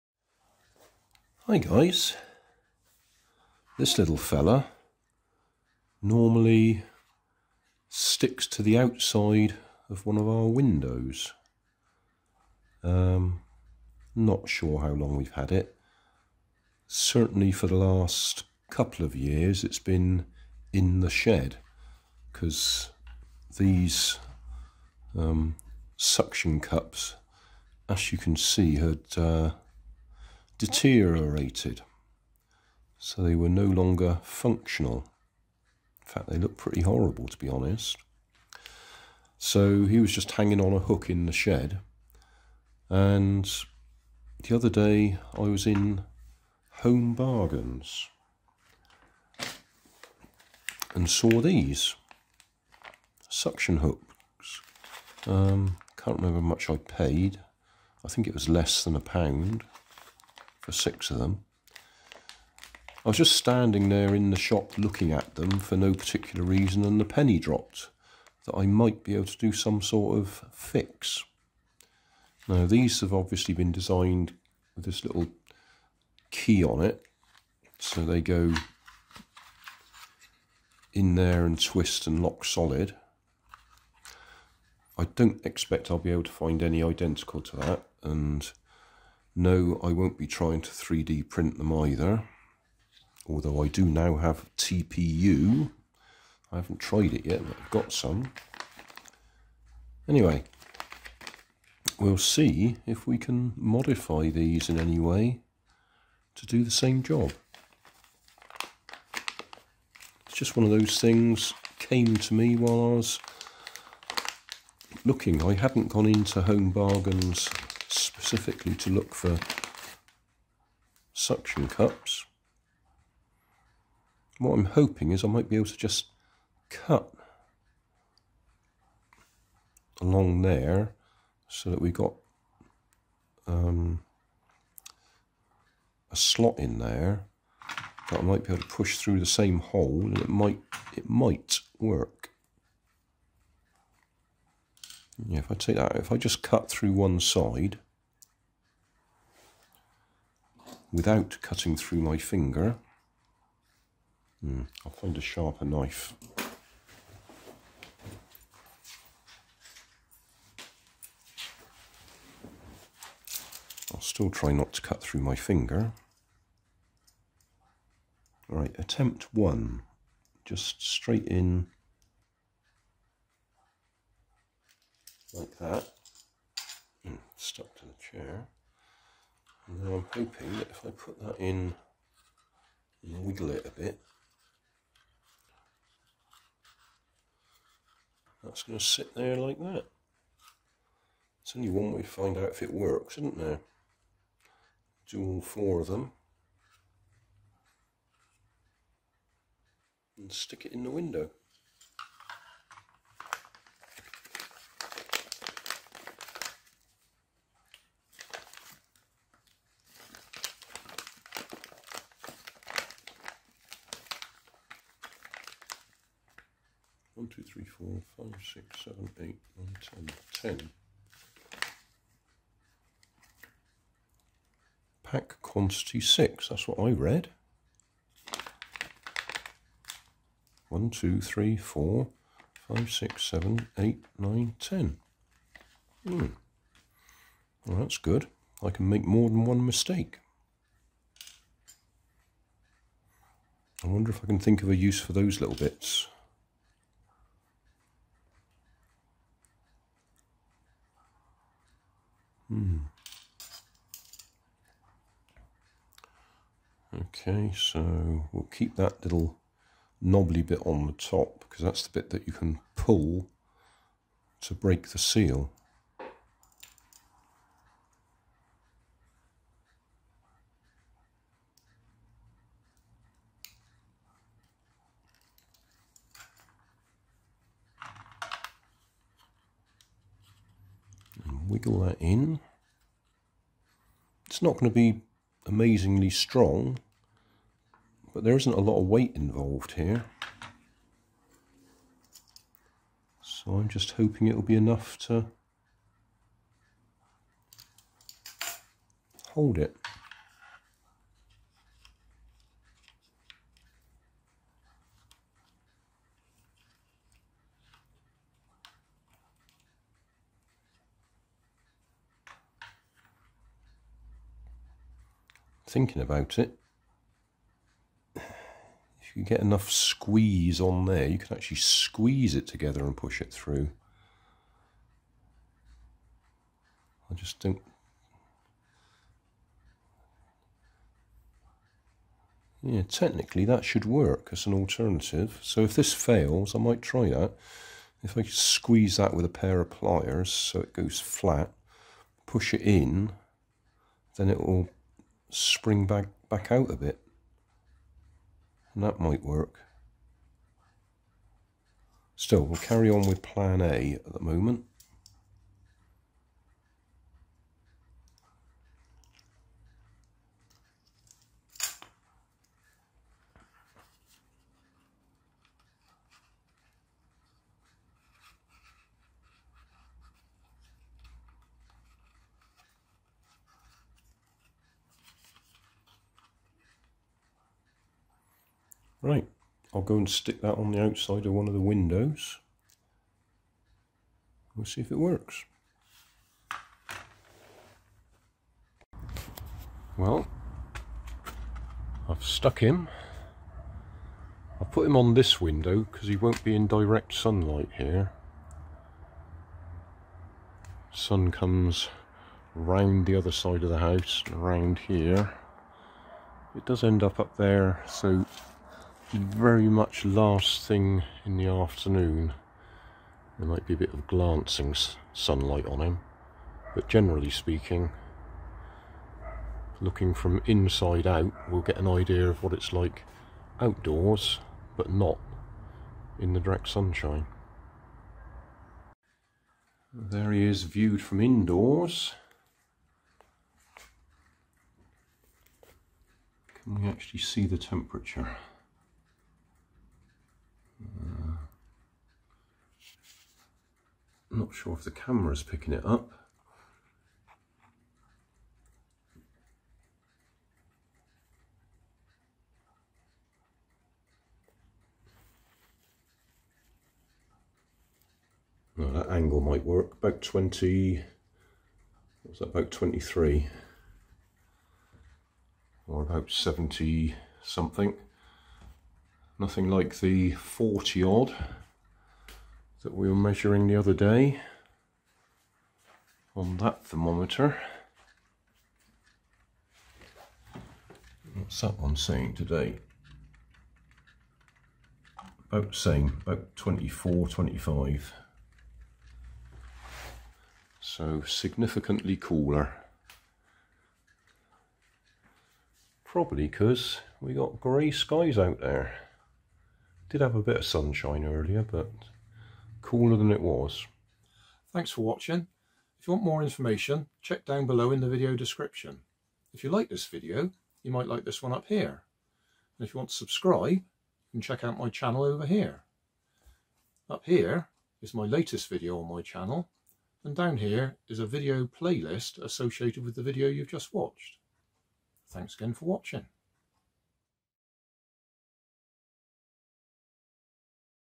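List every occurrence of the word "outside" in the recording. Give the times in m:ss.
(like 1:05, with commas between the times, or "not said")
0:08, 6:20.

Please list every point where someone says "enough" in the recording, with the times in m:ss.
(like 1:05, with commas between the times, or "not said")
4:54, 5:19.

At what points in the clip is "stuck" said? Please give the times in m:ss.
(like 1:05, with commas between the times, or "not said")
2:57, 6:32.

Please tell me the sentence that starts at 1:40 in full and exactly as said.
Anyway, we'll see if we can modify these in any way to do the same job.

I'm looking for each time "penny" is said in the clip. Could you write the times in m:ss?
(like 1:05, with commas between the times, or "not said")
1:07.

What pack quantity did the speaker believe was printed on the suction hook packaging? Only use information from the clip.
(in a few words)
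6.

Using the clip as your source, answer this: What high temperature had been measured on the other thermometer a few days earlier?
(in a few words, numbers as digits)
40 odd.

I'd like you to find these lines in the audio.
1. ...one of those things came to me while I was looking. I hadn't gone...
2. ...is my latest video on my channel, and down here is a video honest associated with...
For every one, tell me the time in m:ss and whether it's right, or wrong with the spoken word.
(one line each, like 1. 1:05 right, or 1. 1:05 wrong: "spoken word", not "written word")
1. 1:50 right
2. 8:38 wrong: "playlist", not "honest".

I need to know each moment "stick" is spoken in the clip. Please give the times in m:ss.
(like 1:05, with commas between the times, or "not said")
0:07, 3:20, 6:20.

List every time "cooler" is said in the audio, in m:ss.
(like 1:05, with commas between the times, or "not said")
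8:12, 8:22.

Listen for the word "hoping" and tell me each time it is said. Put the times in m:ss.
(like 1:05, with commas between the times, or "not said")
2:04, 3:00, 4:53.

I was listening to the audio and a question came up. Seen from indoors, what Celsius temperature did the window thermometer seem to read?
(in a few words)
about 23.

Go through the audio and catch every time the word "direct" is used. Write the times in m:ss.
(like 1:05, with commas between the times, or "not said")
6:36, 7:06.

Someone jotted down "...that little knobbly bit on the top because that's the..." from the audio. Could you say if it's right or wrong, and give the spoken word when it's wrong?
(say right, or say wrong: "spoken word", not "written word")
right.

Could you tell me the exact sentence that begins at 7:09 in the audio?
There he is viewed from indoors.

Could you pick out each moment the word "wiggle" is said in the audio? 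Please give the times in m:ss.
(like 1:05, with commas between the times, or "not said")
3:03, 4:41.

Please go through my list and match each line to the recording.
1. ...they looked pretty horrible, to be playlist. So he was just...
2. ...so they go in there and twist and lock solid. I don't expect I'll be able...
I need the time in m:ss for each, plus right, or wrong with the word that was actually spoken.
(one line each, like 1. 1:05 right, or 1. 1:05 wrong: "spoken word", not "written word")
1. 0:36 wrong: "honest", not "playlist"
2. 1:17 right.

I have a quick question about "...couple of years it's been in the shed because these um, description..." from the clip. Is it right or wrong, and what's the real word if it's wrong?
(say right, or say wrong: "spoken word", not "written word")
wrong: "suction", not "description".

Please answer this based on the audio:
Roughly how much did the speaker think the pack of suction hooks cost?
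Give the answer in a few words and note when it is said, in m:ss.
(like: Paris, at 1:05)
less than a pound, at 0:58.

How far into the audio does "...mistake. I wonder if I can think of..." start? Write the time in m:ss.
3:59.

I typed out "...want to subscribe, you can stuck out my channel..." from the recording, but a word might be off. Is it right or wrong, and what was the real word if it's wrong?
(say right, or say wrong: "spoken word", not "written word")
wrong: "check", not "stuck".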